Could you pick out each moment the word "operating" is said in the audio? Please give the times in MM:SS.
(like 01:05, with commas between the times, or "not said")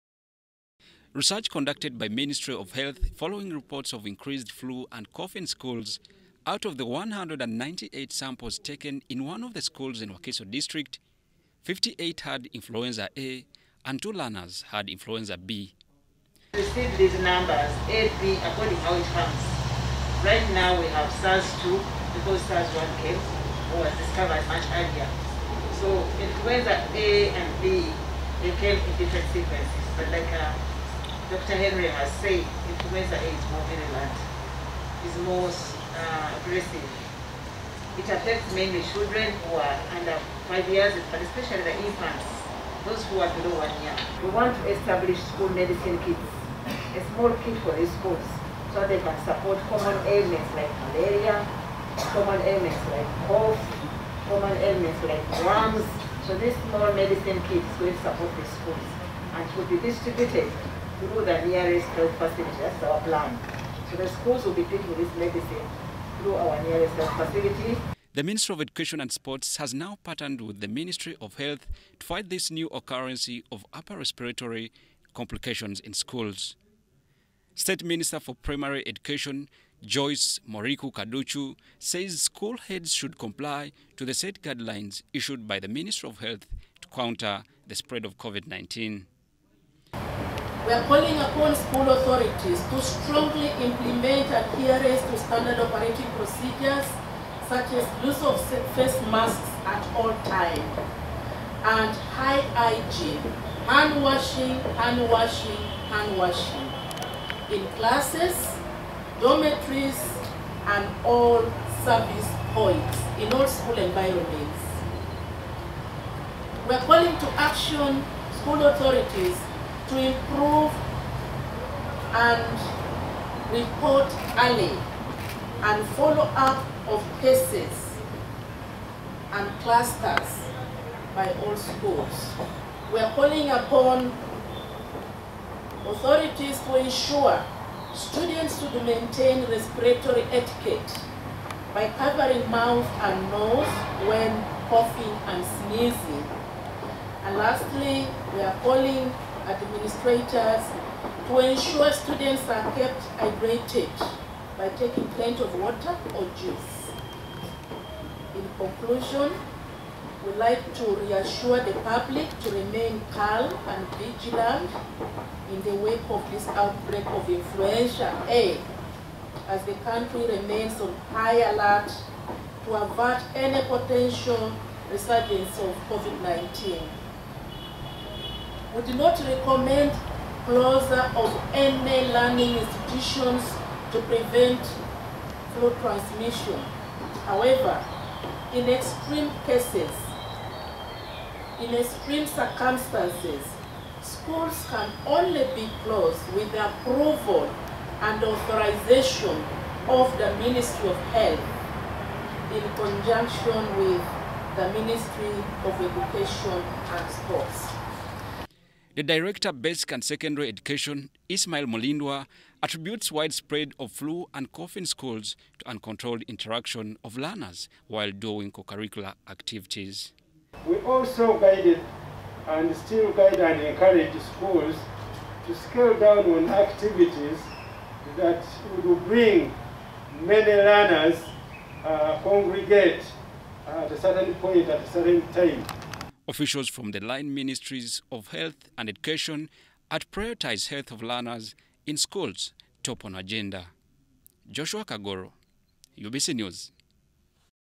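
01:35.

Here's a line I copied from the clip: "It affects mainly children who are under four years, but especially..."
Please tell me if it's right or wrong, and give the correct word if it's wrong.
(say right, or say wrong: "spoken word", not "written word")
wrong: "five", not "four".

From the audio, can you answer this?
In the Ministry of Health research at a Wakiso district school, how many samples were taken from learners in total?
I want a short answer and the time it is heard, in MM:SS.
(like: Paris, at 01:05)
198, at 00:06.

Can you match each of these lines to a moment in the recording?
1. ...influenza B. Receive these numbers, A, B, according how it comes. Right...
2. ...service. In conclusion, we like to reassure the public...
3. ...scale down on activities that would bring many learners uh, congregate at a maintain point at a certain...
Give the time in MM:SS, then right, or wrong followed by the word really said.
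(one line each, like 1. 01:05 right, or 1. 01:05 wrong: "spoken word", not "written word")
1. 00:14 right
2. 02:36 wrong: "juice", not "service"
3. 03:45 wrong: "certain", not "maintain".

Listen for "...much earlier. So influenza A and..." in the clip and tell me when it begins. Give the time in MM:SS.
00:24.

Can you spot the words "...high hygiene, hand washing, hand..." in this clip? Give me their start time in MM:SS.
01:42.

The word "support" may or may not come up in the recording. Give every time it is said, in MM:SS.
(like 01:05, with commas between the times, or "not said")
00:49, 00:58.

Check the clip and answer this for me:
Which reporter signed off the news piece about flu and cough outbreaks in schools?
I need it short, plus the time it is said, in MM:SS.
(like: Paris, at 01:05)
Joshua Kagoro, at 04:04.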